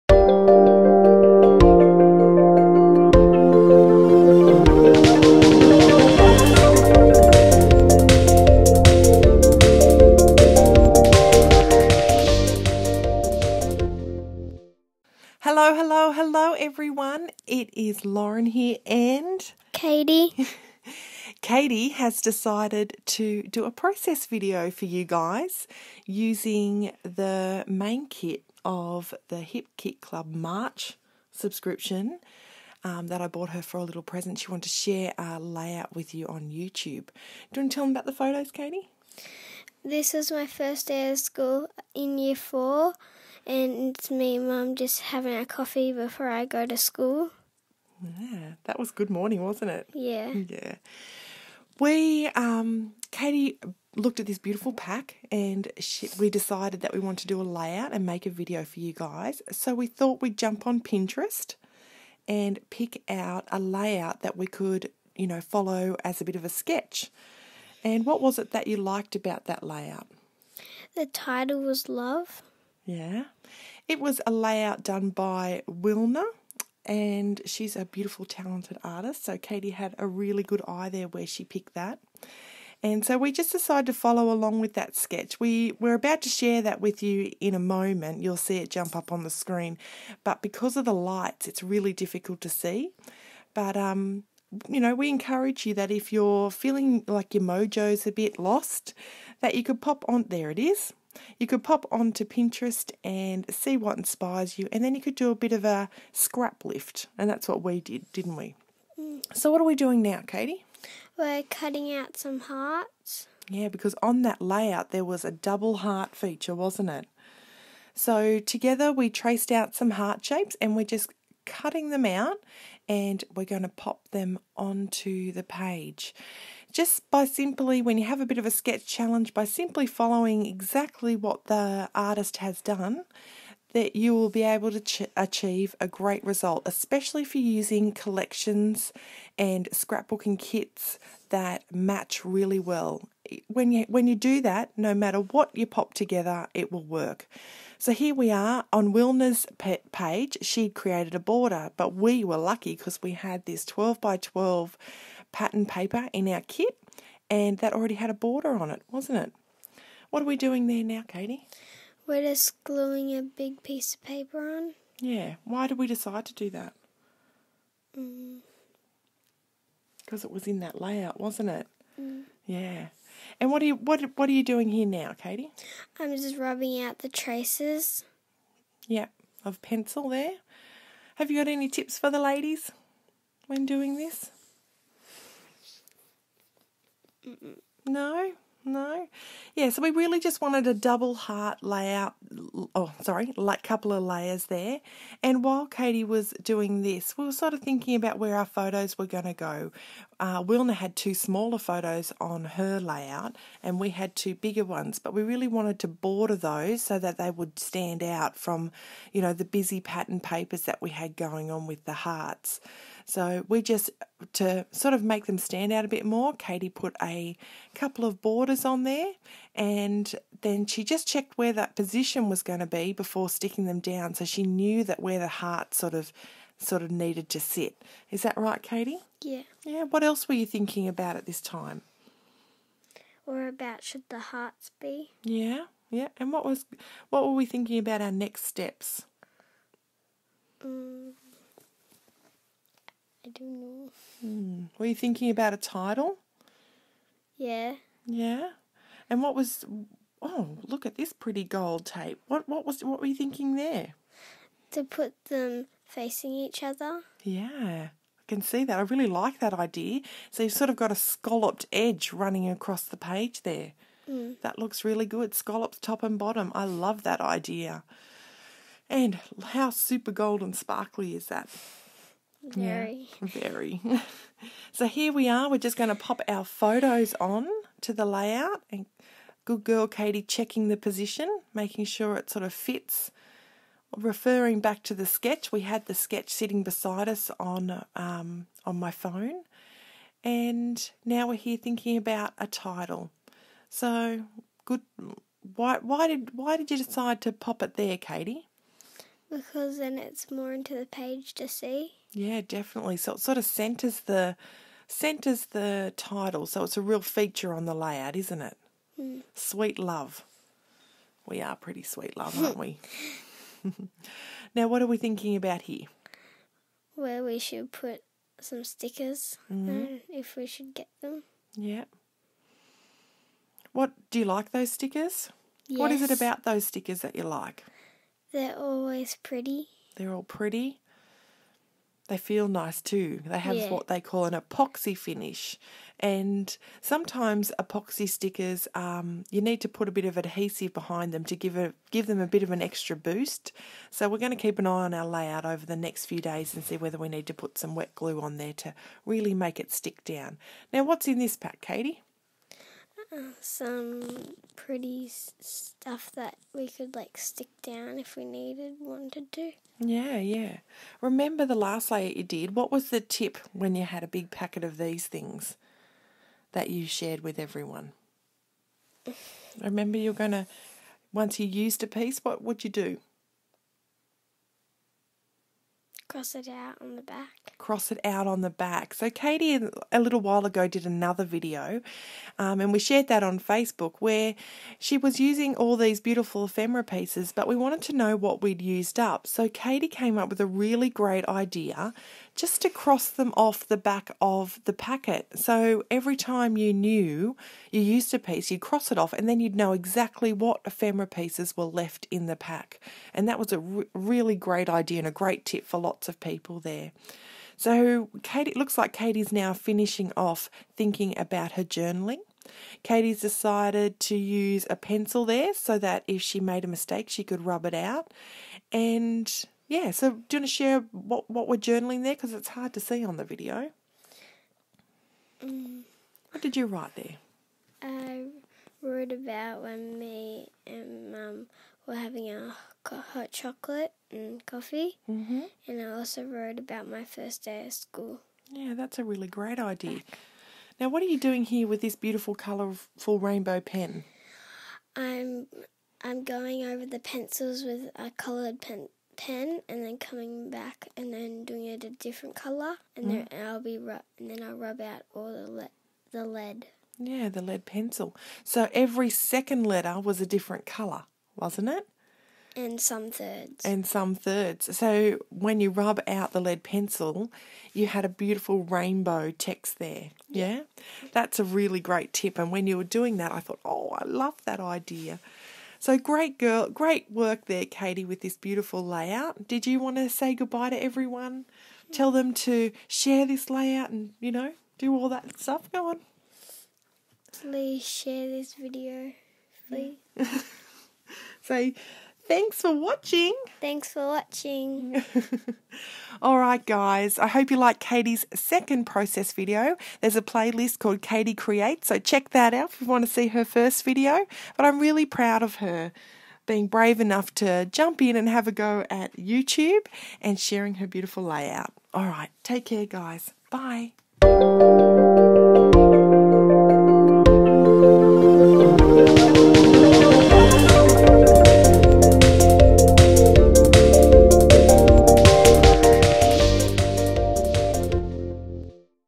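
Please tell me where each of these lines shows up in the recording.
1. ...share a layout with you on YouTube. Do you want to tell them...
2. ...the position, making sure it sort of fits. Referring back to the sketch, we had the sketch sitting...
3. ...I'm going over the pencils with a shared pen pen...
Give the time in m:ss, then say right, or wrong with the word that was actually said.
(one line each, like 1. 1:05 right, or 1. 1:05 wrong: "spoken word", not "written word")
1. 0:34 right
2. 4:40 right
3. 7:26 wrong: "coloured", not "shared".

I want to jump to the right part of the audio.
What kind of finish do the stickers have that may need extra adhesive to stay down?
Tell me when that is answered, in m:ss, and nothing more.
5:34.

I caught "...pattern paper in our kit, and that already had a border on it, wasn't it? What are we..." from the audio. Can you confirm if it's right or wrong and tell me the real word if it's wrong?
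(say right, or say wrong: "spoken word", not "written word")
right.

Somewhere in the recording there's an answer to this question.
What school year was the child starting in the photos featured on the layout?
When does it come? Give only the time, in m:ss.
0:42.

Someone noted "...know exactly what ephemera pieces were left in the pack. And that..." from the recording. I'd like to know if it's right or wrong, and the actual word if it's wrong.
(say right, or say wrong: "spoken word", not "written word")
right.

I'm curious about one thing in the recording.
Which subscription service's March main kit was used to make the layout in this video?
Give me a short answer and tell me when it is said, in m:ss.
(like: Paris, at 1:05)
Hip Kit Club, at 0:29.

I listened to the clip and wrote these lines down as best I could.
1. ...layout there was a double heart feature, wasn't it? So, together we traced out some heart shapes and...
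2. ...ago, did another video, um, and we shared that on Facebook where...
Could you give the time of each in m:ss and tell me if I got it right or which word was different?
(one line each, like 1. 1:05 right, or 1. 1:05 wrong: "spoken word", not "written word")
1. 1:54 right
2. 6:20 right.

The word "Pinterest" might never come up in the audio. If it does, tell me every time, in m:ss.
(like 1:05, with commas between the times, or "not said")
1:00, 1:42.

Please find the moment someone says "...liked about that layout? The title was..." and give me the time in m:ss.
1:08.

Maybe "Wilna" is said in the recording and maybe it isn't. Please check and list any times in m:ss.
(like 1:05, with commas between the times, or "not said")
1:15, 2:28, 3:20.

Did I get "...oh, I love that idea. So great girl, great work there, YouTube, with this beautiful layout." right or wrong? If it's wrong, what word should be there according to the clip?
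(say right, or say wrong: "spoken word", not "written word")
wrong: "Katie", not "YouTube".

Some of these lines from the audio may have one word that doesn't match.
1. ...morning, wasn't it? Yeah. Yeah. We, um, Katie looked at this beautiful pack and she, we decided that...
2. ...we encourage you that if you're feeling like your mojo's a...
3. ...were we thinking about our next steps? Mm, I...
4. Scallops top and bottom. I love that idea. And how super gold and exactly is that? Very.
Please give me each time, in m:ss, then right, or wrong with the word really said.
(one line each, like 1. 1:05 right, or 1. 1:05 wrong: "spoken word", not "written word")
1. 0:49 right
2. 1:34 right
3. 3:57 right
4. 4:25 wrong: "sparkly", not "exactly".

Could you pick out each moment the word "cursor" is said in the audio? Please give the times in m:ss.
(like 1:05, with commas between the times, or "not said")
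not said.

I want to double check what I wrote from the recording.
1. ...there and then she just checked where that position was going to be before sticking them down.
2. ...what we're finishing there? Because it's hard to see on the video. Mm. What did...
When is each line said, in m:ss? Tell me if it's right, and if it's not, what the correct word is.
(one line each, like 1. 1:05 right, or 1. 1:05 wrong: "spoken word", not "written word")
1. 3:38 right
2. 7:01 wrong: "journaling", not "finishing".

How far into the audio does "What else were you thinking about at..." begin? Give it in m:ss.
3:49.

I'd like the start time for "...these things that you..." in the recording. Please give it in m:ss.
6:04.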